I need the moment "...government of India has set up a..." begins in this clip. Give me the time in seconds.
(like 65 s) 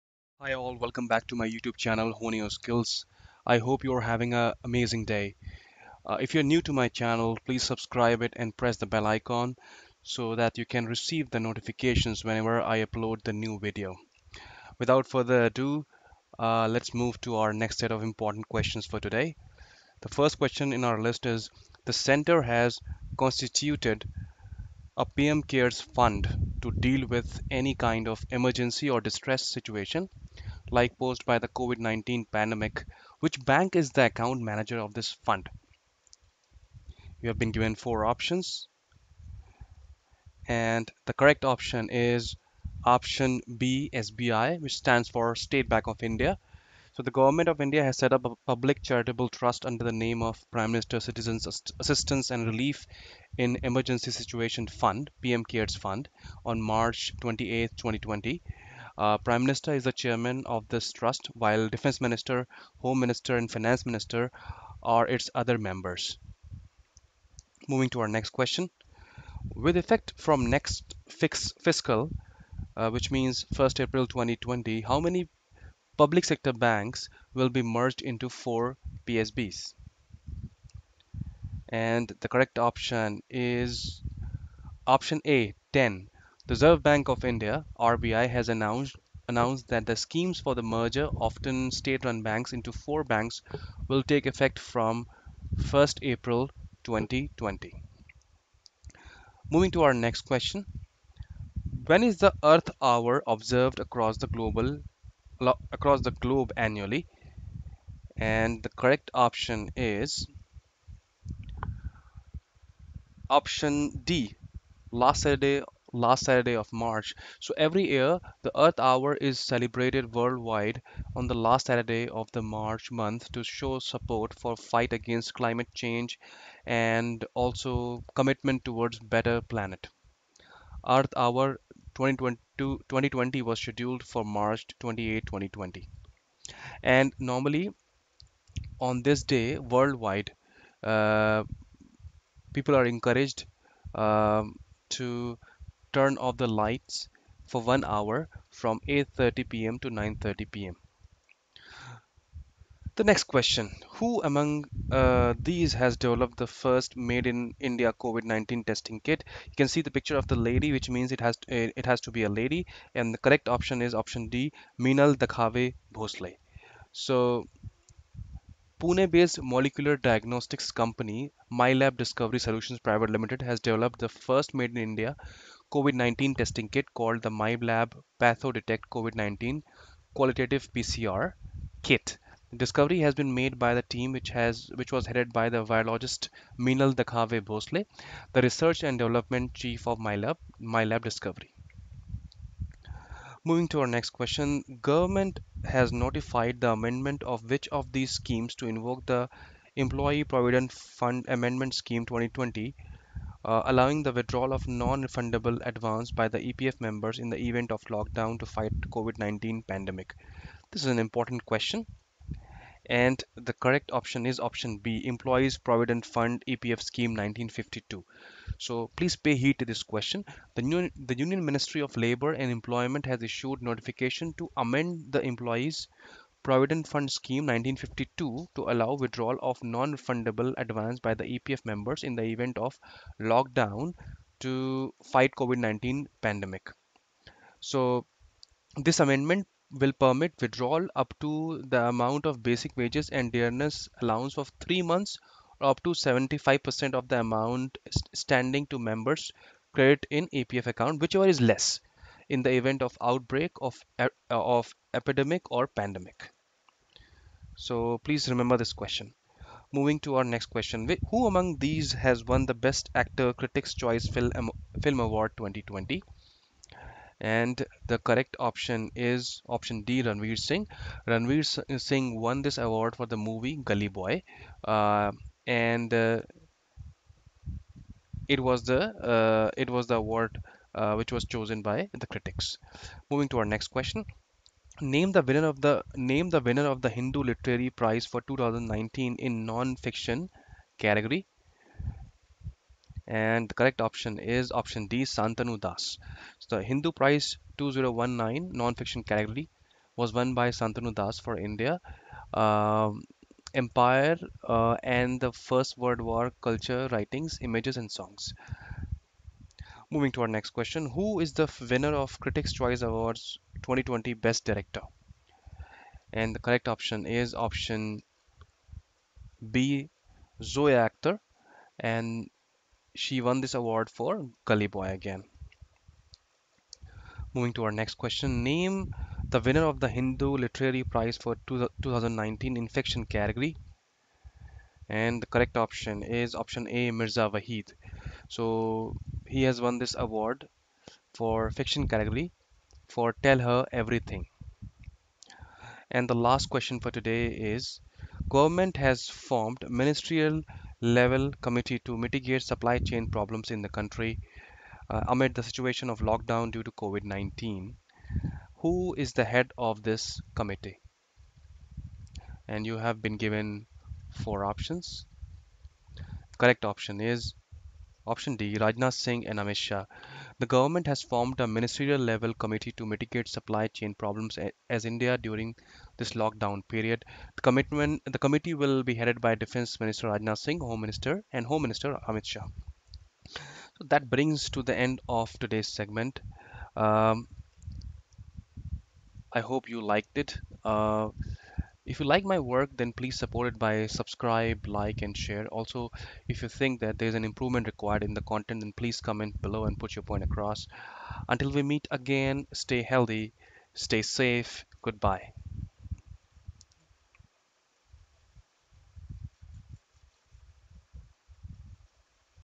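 47 s.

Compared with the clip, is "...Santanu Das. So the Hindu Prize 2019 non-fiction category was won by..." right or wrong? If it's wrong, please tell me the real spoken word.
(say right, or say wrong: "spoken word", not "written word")
right.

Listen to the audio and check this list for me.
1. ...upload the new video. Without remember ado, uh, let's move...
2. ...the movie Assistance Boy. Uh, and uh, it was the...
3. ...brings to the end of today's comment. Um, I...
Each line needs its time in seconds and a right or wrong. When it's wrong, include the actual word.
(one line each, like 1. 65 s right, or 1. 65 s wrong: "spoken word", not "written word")
1. 12 s wrong: "further", not "remember"
2. 273 s wrong: "Gully", not "Assistance"
3. 384 s wrong: "segment", not "comment".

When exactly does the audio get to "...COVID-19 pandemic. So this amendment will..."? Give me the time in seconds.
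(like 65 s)
235 s.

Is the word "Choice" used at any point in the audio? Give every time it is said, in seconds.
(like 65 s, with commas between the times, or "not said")
263 s, 312 s.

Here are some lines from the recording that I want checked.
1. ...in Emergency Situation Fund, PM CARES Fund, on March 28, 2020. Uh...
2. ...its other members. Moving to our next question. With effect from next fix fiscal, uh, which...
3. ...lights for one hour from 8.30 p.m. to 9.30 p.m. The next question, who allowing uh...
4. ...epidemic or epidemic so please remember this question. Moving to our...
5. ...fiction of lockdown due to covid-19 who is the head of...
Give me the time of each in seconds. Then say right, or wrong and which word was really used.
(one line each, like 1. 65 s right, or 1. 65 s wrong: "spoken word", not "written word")
1. 53 s right
2. 65 s right
3. 146 s wrong: "among", not "allowing"
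4. 254 s wrong: "pandemic", not "epidemic"
5. 355 s wrong: "situation", not "fiction".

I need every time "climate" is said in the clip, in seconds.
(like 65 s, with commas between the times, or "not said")
125 s.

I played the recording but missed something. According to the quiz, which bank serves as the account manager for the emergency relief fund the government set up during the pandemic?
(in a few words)
SBI.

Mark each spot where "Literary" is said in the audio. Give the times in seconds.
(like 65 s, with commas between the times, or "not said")
287 s, 330 s.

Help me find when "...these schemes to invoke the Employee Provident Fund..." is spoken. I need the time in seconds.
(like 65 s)
197 s.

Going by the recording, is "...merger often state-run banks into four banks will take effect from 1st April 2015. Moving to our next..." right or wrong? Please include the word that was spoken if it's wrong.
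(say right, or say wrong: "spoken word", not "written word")
wrong: "2020", not "2015".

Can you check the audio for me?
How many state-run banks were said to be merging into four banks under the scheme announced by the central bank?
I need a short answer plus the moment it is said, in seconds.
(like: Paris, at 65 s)
10, at 85 s.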